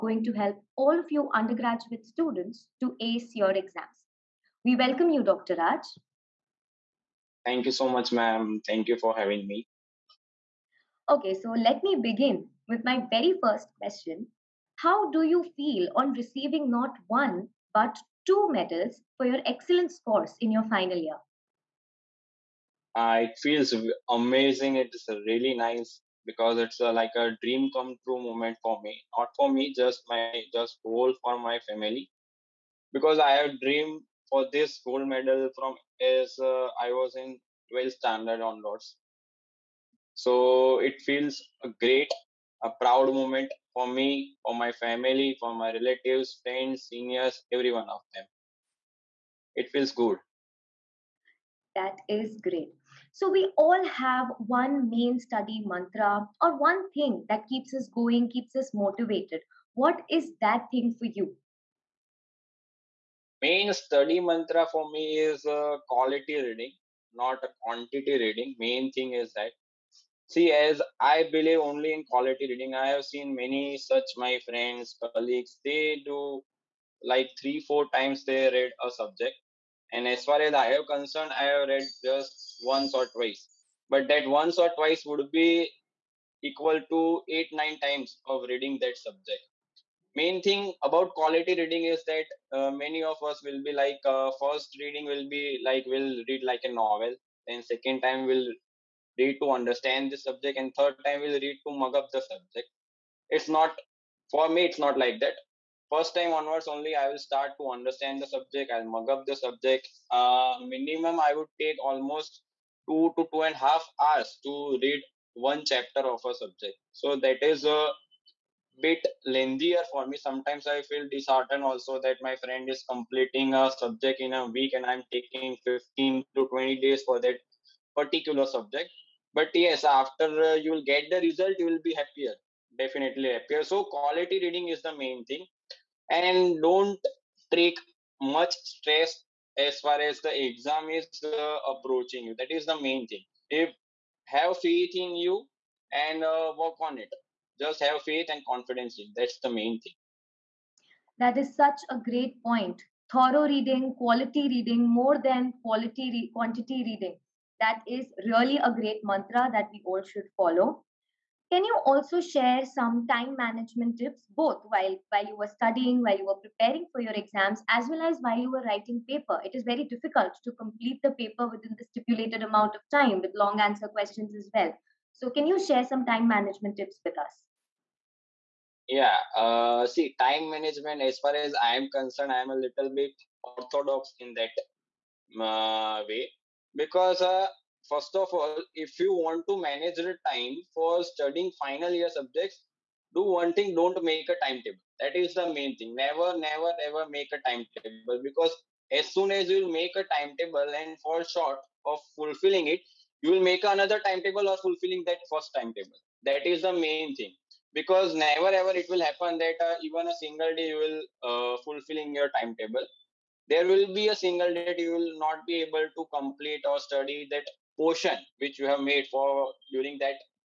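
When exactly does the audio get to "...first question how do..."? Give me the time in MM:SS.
00:13.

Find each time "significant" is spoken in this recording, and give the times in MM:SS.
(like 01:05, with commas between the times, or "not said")
not said.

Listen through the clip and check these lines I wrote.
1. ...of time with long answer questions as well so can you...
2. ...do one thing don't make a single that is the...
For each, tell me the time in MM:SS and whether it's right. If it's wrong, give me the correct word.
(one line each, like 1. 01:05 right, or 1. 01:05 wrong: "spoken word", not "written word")
1. 02:52 right
2. 03:13 wrong: "timetable", not "single".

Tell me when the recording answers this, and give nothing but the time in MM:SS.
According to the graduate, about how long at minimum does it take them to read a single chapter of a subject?
01:52.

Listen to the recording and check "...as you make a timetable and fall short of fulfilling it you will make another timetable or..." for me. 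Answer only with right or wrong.
right.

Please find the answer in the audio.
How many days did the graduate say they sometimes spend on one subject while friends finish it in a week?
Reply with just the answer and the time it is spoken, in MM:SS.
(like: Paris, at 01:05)
15 to 20 days, at 02:05.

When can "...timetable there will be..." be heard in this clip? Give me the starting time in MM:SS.
03:32.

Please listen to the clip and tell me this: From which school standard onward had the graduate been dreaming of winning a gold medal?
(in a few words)
12th standard.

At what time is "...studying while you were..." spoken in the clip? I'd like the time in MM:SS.
02:45.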